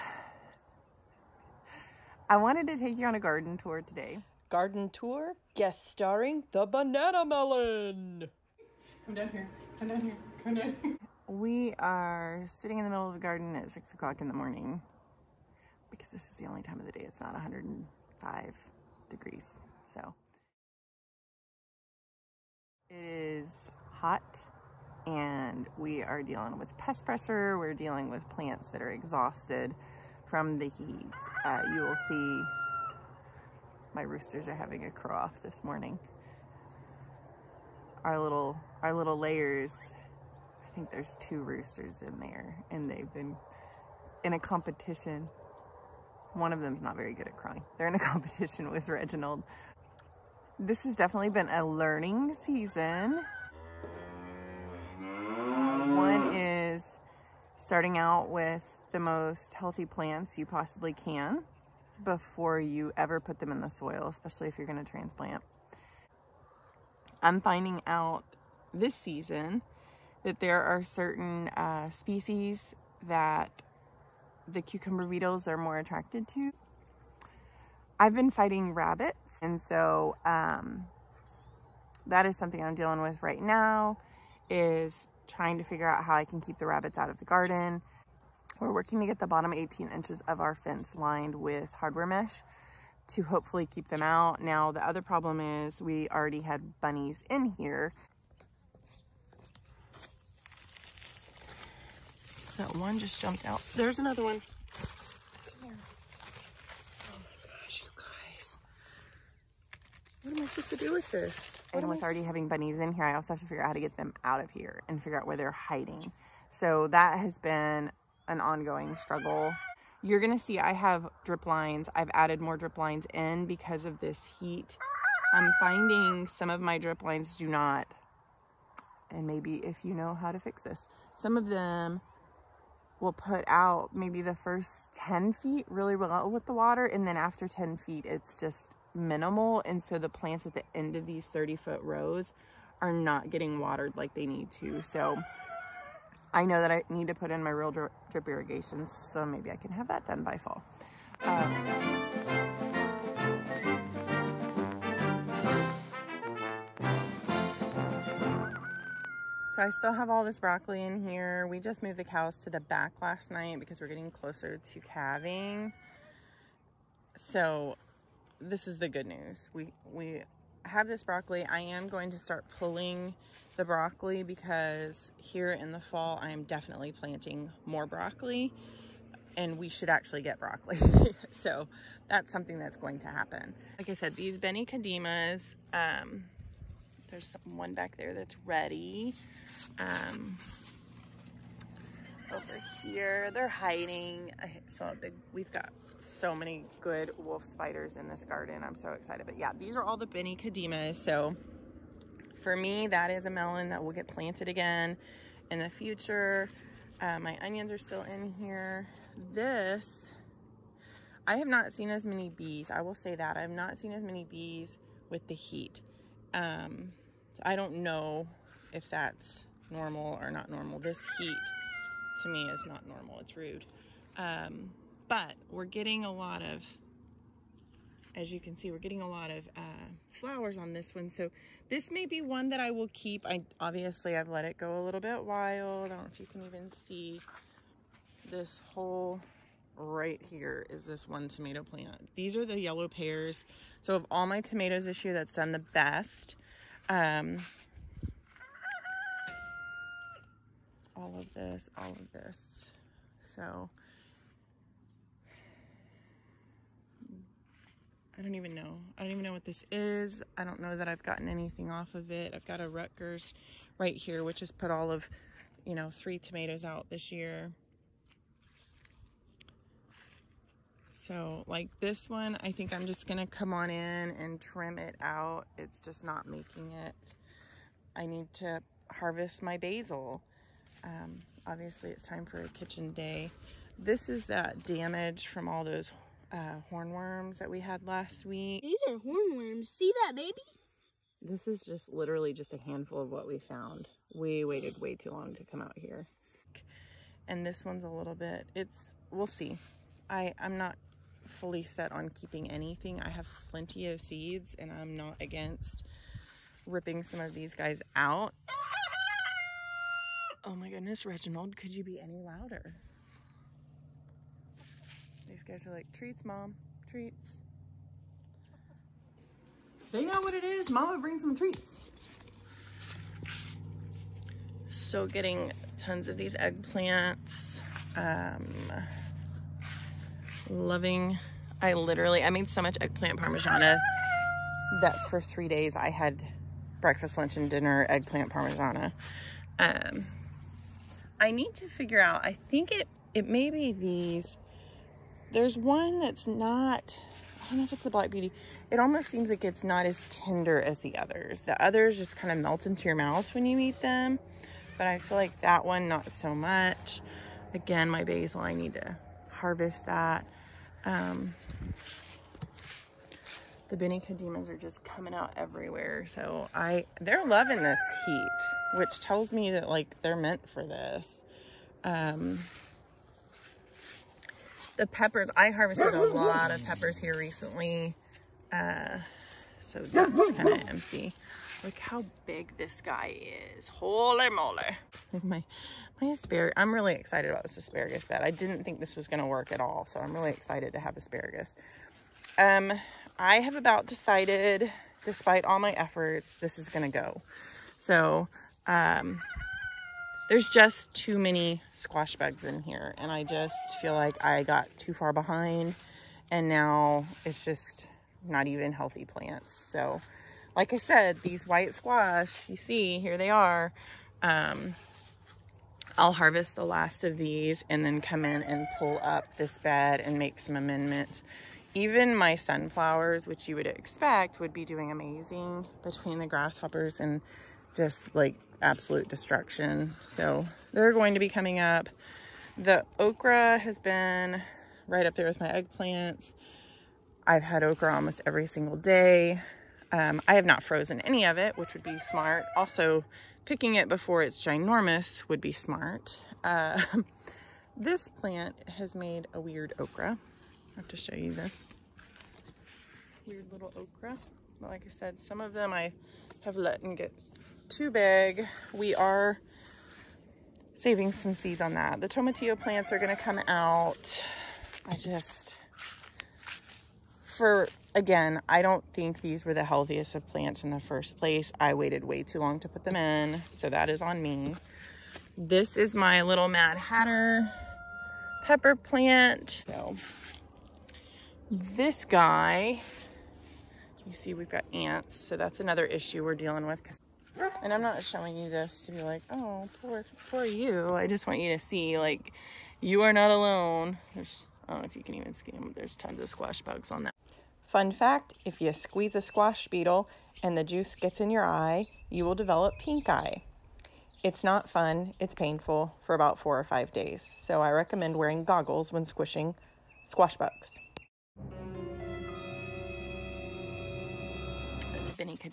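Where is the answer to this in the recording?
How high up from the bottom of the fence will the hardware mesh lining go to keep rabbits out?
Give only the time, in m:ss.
1:29.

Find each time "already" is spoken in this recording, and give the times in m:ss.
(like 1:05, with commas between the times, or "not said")
1:36, 1:52.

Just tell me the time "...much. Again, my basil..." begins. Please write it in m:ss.
5:56.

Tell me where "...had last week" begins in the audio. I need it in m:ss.
4:47.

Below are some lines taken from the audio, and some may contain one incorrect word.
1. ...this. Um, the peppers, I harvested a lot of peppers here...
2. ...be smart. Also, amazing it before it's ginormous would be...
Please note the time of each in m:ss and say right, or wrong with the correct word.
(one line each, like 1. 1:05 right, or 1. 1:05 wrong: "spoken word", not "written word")
1. 6:10 right
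2. 7:21 wrong: "picking", not "amazing".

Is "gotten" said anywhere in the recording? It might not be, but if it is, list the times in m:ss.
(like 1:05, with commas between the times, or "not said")
4:21.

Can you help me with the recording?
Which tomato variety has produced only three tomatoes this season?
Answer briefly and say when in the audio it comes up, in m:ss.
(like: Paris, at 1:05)
Rutgers, at 4:22.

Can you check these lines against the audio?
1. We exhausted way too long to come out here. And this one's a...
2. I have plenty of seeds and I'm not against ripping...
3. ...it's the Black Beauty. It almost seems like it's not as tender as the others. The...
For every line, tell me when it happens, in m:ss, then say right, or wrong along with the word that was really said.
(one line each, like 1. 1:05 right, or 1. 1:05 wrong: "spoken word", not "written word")
1. 4:54 wrong: "waited", not "exhausted"
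2. 5:03 right
3. 5:47 right.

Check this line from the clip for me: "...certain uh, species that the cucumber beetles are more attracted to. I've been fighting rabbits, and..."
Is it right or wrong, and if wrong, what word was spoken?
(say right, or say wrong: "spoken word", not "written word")
right.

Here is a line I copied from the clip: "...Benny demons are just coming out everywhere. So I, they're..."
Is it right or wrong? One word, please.
right.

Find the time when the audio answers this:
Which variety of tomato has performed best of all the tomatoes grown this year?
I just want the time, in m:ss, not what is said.
4:02.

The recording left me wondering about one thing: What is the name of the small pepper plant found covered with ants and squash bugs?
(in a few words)
Mad Hatter.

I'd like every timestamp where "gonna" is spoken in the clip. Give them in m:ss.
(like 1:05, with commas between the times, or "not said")
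2:00, 4:33, 7:42.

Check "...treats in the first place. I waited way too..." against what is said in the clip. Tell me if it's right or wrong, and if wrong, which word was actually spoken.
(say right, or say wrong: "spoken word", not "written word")
wrong: "plants", not "treats".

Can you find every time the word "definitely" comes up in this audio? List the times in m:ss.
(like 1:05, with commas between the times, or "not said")
0:50, 2:56.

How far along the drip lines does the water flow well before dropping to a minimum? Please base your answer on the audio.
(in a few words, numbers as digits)
10 feet.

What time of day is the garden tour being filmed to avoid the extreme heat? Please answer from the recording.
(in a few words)
6 o'clock in the morning.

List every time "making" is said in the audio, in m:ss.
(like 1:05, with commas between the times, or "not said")
4:36.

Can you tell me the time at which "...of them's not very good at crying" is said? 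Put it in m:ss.
0:46.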